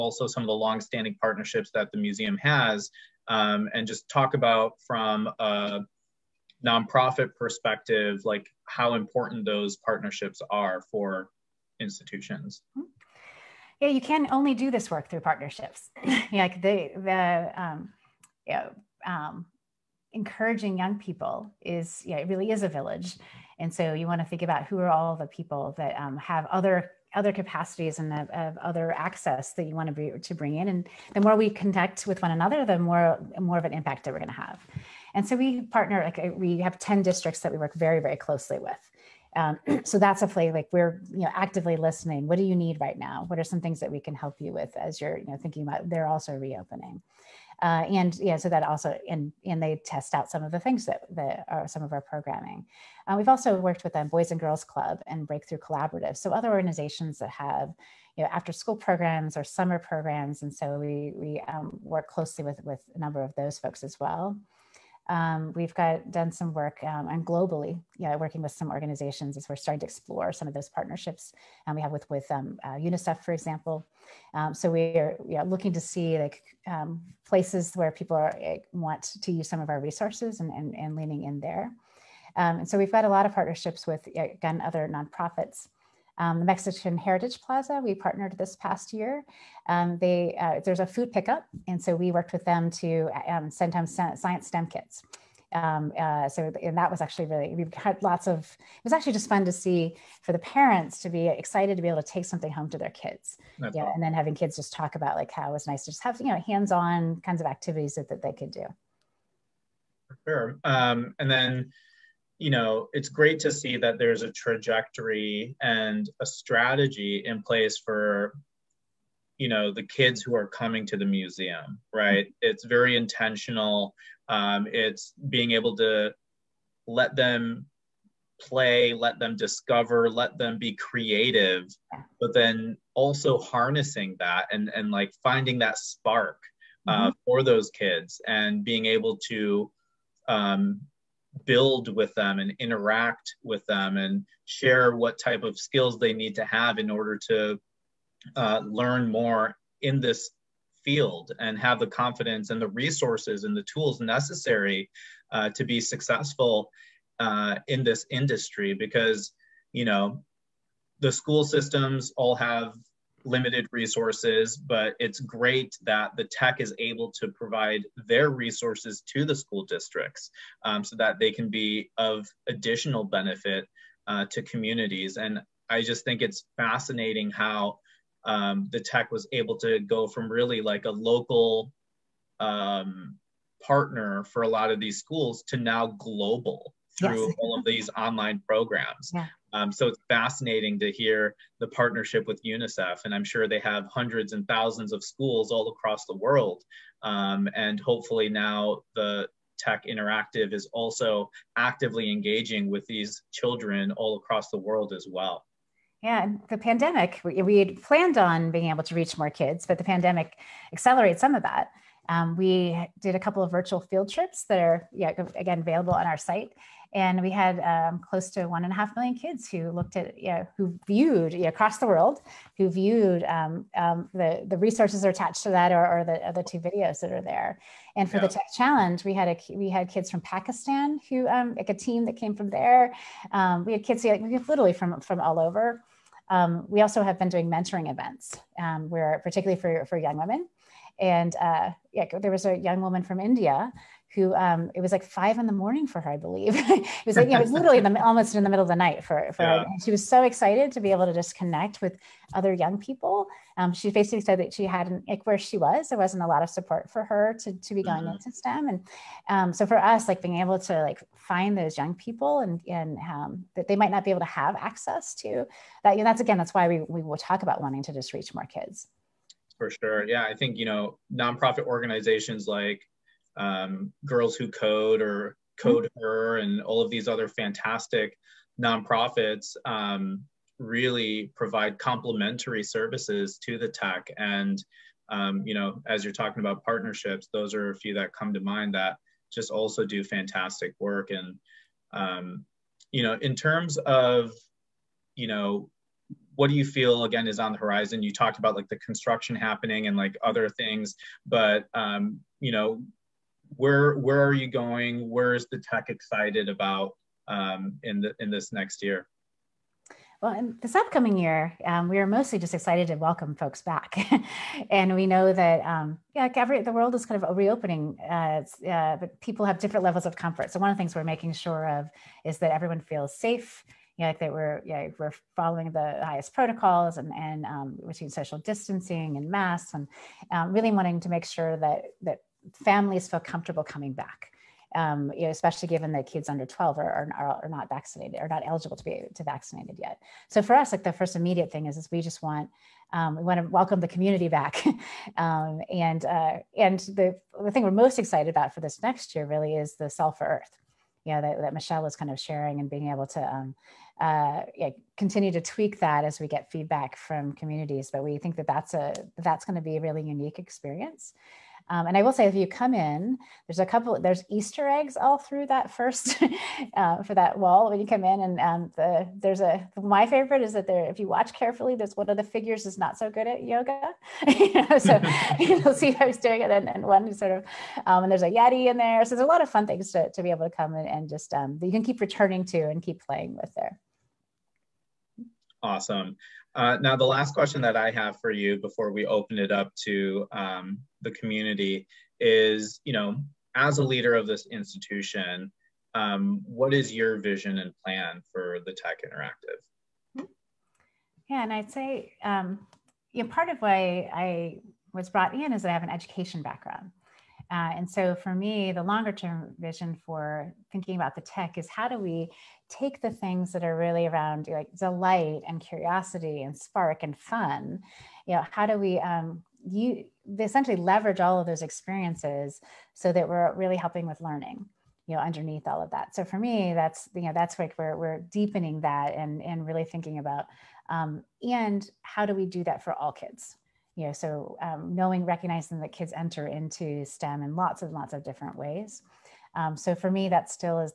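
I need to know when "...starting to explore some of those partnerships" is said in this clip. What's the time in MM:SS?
01:09.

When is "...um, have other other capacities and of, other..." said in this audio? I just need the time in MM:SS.
00:25.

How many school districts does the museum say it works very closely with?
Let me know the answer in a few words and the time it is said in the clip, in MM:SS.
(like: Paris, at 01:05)
10, at 00:36.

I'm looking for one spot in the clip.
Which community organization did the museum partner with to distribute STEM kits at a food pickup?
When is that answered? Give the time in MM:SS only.
01:26.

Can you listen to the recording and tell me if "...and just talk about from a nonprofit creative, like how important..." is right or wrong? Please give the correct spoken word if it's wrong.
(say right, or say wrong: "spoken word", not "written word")
wrong: "perspective", not "creative".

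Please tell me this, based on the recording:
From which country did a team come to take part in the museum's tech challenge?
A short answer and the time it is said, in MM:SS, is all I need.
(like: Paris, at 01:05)
Pakistan, at 03:50.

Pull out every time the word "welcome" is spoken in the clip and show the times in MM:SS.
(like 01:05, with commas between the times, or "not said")
05:12, 05:43.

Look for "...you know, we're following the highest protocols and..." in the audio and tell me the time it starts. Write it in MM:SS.
05:24.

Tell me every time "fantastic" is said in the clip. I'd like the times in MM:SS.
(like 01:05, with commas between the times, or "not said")
04:37, 04:50.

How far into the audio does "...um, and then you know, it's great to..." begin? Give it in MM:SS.
01:50.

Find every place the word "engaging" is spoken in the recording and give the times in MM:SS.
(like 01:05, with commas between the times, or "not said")
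03:22.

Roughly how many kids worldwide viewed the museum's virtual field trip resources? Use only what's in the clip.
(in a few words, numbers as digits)
1.5 million.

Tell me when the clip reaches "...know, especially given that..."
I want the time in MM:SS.
05:35.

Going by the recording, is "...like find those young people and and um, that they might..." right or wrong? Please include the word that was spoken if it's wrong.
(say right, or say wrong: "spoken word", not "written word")
right.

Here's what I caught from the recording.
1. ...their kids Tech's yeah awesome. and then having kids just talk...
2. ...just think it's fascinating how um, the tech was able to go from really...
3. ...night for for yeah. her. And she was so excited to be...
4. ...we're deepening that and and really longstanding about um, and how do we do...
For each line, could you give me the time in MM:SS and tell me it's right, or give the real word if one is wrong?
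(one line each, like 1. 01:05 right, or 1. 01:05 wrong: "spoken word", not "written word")
1. 01:42 wrong: "That", not "Tech"
2. 02:55 right
3. 04:08 right
4. 07:07 wrong: "thinking", not "longstanding".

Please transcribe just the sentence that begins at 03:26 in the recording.
Yeah, the pandemic, we, we had planned on being able to reach more kids, but the pandemic accelerates some of that.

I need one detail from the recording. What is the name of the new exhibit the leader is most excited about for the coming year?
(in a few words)
Solve for Earth.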